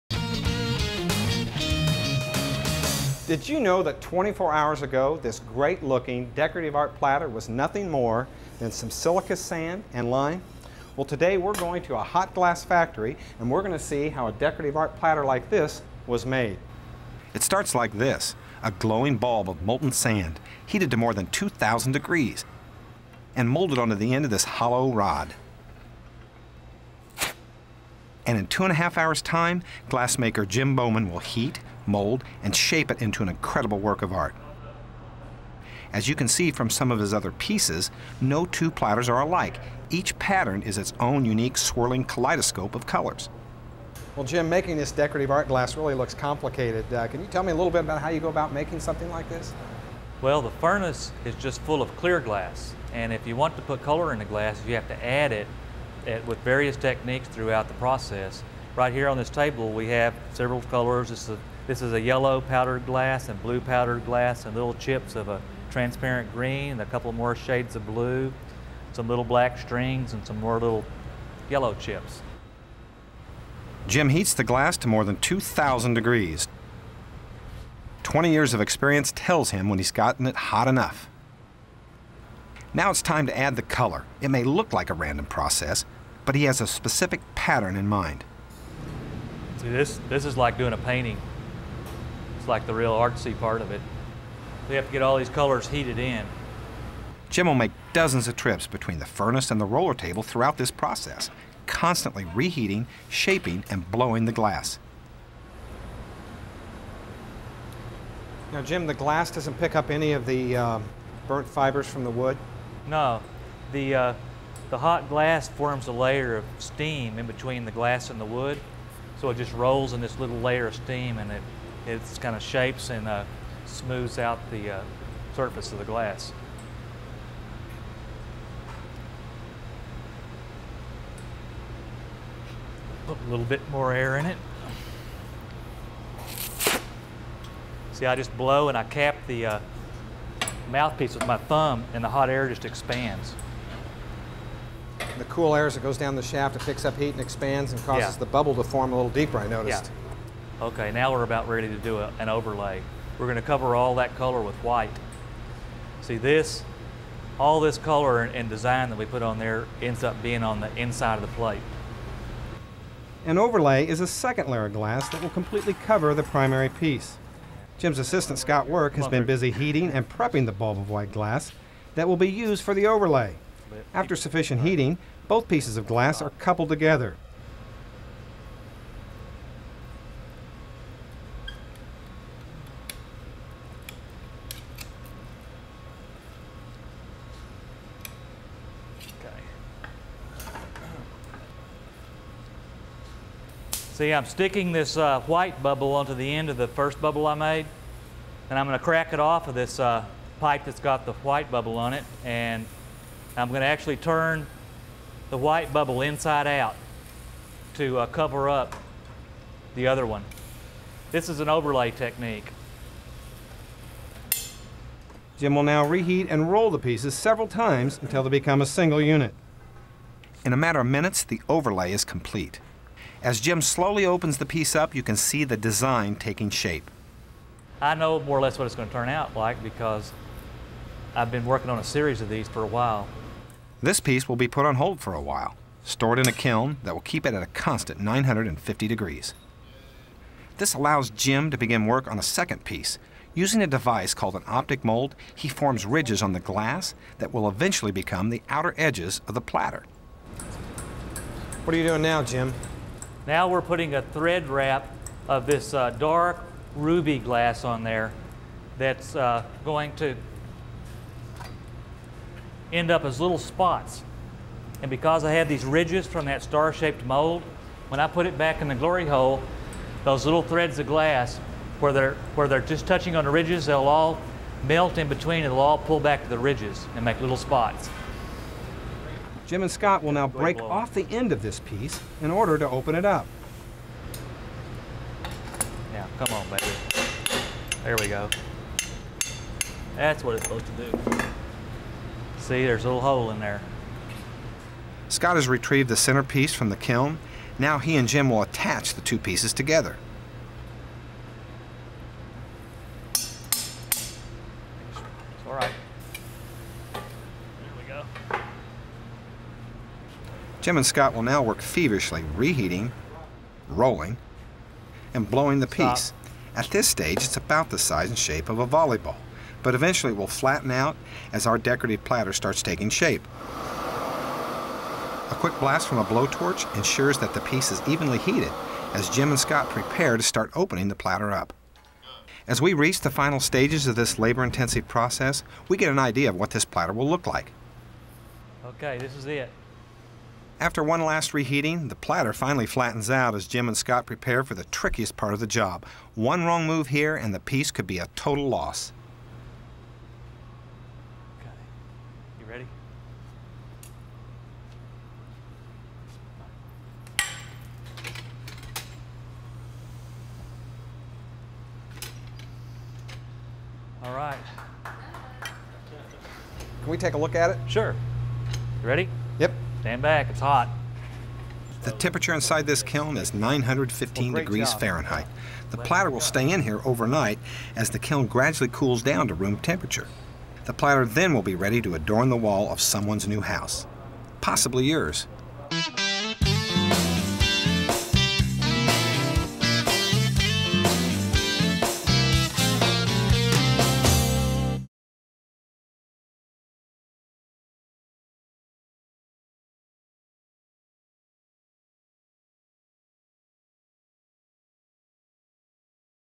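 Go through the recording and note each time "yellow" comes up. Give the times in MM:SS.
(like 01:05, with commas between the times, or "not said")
01:02, 01:11.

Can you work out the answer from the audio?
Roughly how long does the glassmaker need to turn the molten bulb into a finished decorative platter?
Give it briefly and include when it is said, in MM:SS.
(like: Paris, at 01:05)
2.5 hours, at 00:28.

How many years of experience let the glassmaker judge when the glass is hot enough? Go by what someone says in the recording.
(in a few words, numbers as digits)
20.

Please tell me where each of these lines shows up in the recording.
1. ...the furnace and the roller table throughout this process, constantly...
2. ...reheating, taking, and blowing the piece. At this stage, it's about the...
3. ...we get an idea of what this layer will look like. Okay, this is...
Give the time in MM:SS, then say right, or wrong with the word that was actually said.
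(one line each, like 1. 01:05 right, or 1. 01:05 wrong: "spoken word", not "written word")
1. 01:38 right
2. 05:12 wrong: "rolling", not "taking"
3. 05:35 wrong: "platter", not "layer".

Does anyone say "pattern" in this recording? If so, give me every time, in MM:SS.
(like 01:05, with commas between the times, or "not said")
00:40, 01:27.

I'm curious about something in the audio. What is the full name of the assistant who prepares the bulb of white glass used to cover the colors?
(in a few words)
Scott Work.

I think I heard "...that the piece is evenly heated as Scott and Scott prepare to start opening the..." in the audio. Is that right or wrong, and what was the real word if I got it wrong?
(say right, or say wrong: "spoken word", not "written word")
wrong: "Jim", not "Scott".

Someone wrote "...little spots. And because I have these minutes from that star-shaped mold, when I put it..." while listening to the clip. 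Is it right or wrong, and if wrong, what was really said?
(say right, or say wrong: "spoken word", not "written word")
wrong: "ridges", not "minutes".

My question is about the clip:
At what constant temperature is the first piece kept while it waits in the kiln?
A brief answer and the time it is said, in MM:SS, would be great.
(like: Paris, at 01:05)
950 degrees, at 03:57.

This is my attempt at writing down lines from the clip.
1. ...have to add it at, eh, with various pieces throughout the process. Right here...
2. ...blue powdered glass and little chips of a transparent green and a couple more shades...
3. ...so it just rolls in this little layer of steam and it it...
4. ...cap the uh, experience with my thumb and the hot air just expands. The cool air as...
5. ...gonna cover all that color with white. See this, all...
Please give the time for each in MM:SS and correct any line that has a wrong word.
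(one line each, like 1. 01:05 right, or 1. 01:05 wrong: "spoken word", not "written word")
1. 00:54 wrong: "techniques", not "pieces"
2. 01:03 right
3. 01:59 right
4. 02:18 wrong: "mouthpiece", not "experience"
5. 02:33 right.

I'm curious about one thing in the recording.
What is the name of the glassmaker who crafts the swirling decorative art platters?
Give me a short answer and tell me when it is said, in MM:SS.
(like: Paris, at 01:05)
Jim Bowman, at 00:30.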